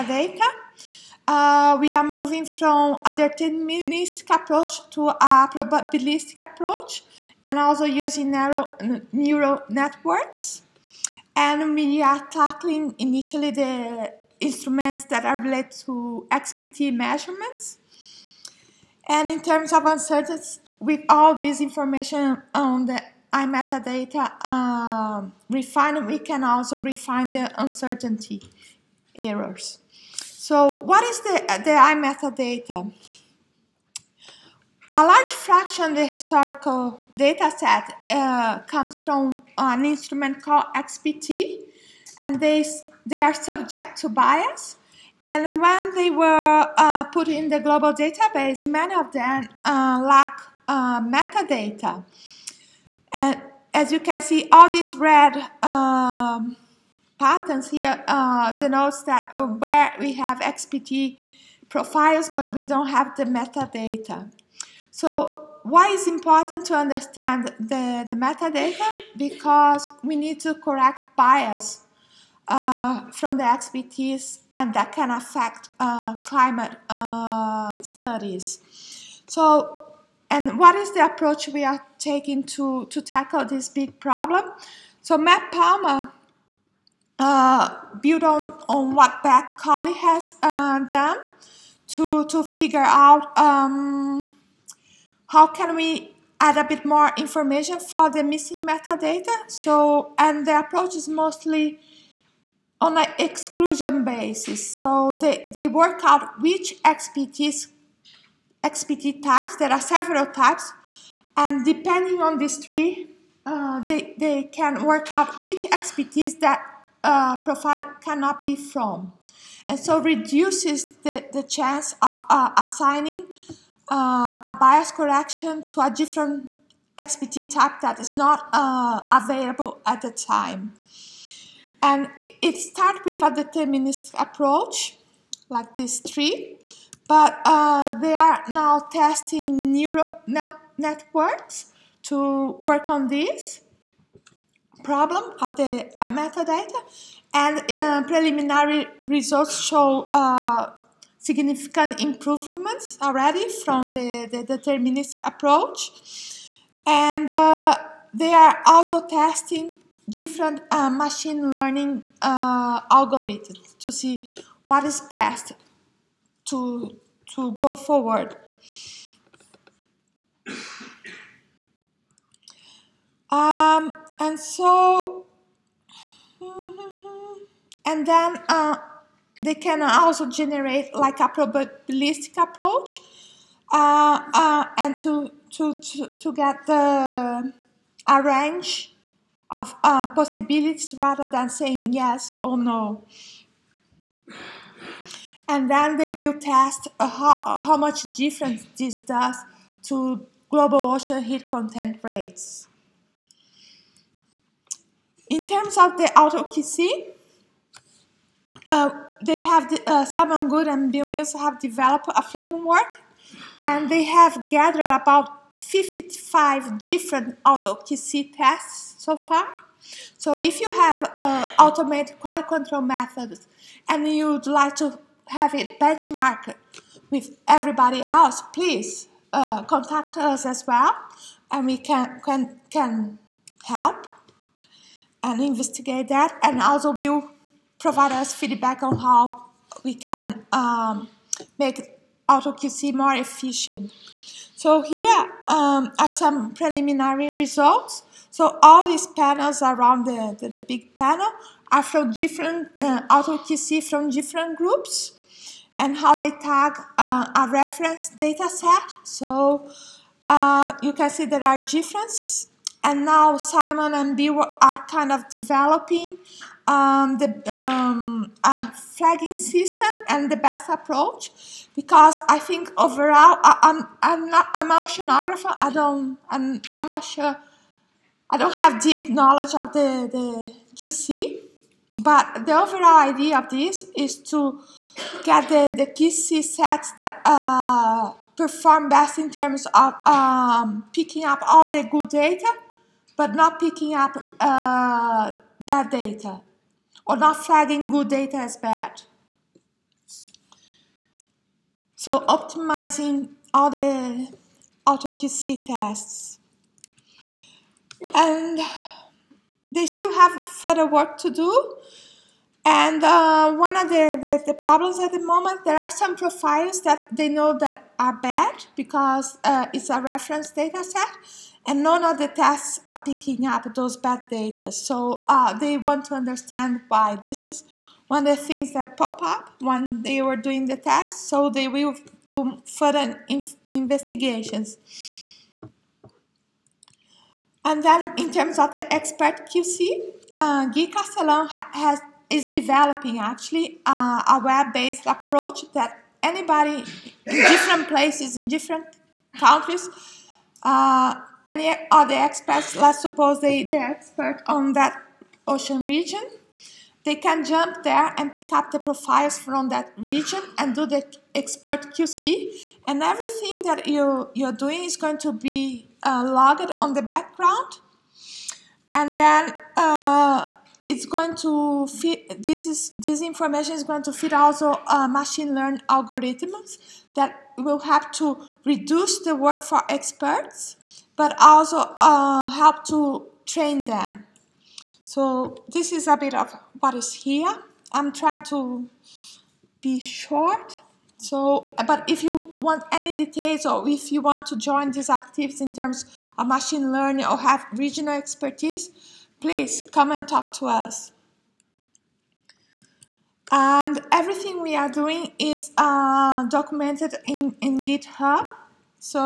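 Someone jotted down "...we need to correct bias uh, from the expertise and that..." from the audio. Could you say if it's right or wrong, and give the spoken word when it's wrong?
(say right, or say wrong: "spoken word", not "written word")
right.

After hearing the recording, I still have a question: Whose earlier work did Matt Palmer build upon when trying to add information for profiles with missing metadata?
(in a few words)
Bec Cowley.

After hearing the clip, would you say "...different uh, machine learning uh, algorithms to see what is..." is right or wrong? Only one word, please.
right.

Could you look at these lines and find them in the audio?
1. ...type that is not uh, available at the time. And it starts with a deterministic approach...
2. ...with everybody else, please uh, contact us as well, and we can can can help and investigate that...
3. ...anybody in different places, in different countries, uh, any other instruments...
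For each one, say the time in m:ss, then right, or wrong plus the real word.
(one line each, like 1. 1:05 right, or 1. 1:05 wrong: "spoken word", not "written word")
1. 2:07 right
2. 3:47 right
3. 5:46 wrong: "experts", not "instruments".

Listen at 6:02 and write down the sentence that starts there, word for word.
And everything that you, you're doing is going to be uh, logged on the background.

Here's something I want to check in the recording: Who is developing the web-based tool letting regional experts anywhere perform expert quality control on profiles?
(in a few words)
Gui Castelão.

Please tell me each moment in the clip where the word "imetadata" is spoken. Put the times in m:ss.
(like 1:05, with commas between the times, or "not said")
0:23, 0:31, 2:25.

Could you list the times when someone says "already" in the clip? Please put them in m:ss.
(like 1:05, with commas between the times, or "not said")
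2:33.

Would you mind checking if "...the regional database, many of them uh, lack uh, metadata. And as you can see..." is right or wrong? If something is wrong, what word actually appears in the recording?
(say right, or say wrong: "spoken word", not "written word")
wrong: "global", not "regional".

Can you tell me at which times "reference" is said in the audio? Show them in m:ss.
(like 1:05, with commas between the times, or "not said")
4:17, 5:19.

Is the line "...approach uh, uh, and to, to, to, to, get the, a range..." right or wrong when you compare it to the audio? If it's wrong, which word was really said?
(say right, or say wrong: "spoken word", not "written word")
right.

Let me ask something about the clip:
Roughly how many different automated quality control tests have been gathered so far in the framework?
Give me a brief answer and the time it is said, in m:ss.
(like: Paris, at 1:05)
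55, at 3:35.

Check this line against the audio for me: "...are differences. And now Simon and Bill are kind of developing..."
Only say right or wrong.
right.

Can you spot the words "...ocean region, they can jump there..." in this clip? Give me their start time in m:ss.
5:55.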